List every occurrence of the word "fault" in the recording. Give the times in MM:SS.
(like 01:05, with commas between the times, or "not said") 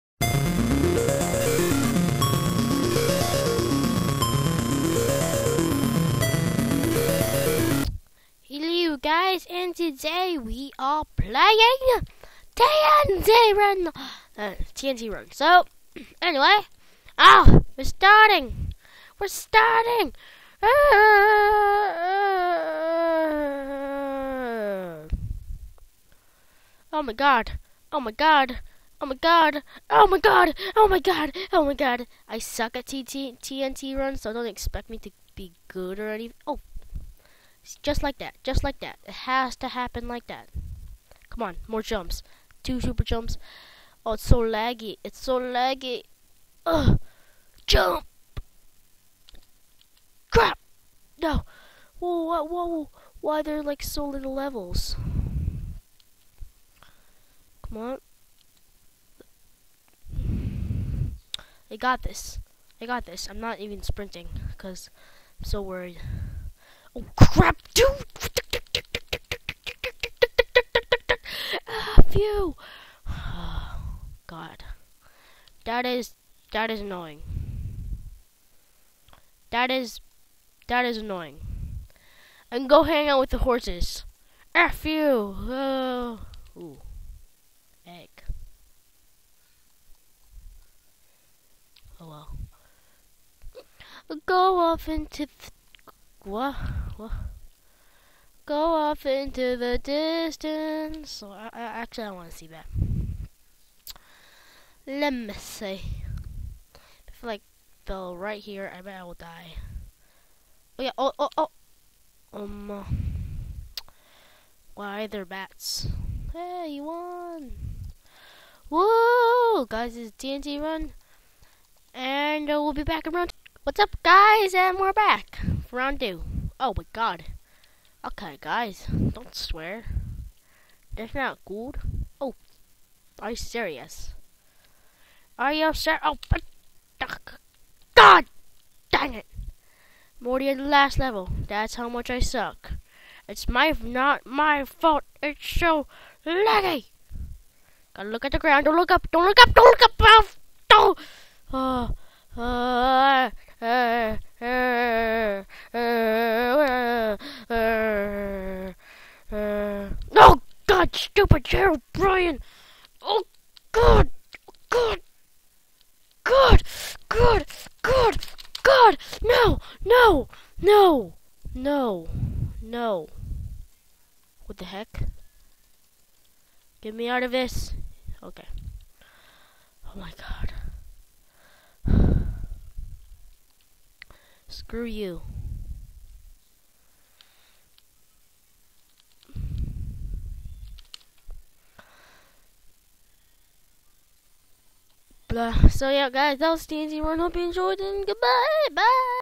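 02:24.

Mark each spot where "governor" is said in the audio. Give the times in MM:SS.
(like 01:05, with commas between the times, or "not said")
not said.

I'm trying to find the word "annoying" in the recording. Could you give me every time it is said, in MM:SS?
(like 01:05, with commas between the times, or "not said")
01:16, 01:20.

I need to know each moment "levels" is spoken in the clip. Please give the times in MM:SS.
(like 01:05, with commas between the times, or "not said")
00:54, 02:20.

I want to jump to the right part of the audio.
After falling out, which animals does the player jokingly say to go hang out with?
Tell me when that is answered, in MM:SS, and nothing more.
01:23.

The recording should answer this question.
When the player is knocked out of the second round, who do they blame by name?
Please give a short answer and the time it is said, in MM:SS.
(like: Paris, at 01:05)
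Gerald Bryan, at 02:41.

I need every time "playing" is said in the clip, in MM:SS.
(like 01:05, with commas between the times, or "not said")
00:11.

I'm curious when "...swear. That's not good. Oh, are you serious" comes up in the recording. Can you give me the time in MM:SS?
02:09.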